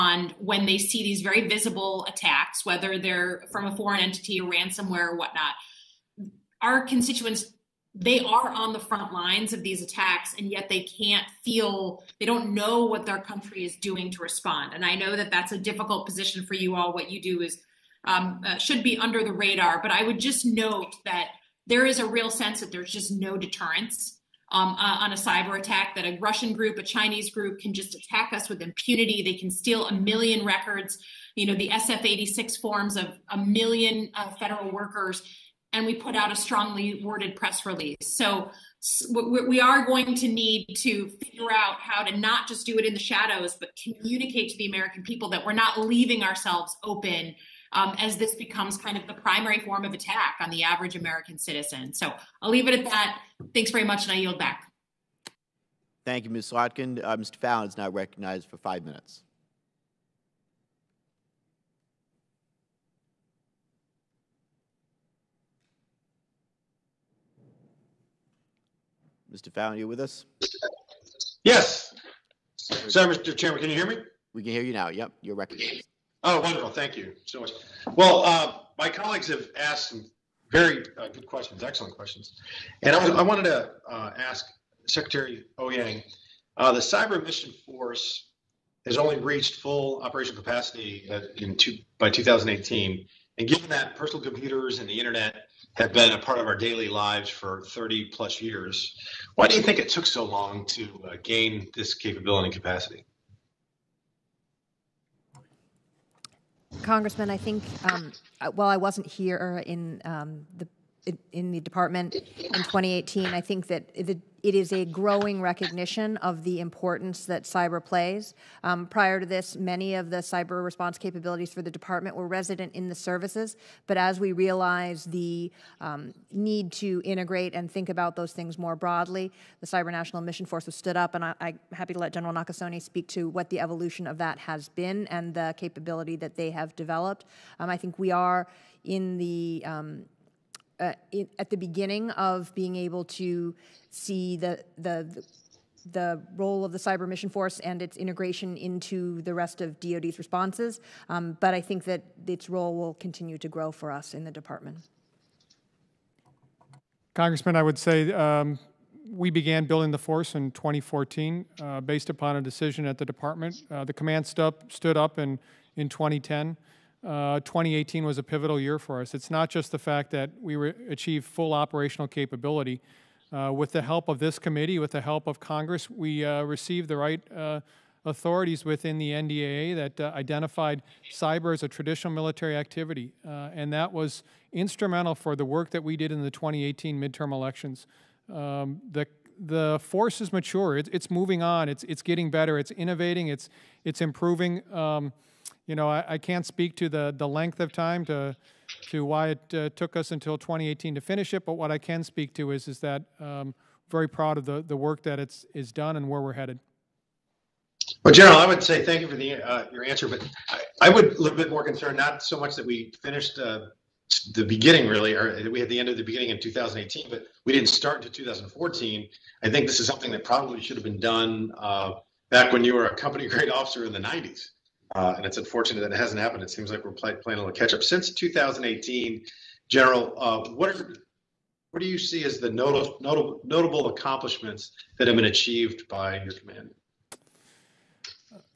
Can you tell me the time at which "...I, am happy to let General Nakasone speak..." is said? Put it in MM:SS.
02:11.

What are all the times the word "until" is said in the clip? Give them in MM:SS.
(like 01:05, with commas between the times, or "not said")
03:20, 03:37.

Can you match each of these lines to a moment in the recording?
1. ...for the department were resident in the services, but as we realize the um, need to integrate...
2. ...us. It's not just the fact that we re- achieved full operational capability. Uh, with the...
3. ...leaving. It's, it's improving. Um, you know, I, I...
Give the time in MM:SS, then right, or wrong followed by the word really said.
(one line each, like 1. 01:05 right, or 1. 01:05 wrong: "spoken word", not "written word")
1. 02:01 right
2. 02:49 right
3. 03:12 wrong: "innovating", not "leaving".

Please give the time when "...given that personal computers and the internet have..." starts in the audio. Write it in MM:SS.
01:33.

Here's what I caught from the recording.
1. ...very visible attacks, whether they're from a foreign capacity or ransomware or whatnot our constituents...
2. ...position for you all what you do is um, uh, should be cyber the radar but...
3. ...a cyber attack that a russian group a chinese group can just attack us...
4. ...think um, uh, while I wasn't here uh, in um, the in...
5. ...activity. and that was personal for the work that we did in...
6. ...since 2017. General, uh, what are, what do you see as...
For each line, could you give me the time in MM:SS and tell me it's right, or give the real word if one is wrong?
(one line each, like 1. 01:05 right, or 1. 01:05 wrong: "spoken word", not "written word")
1. 00:01 wrong: "entity", not "capacity"
2. 00:16 wrong: "under", not "cyber"
3. 00:25 right
4. 01:47 right
5. 03:02 wrong: "instrumental", not "personal"
6. 03:47 wrong: "2018", not "2017".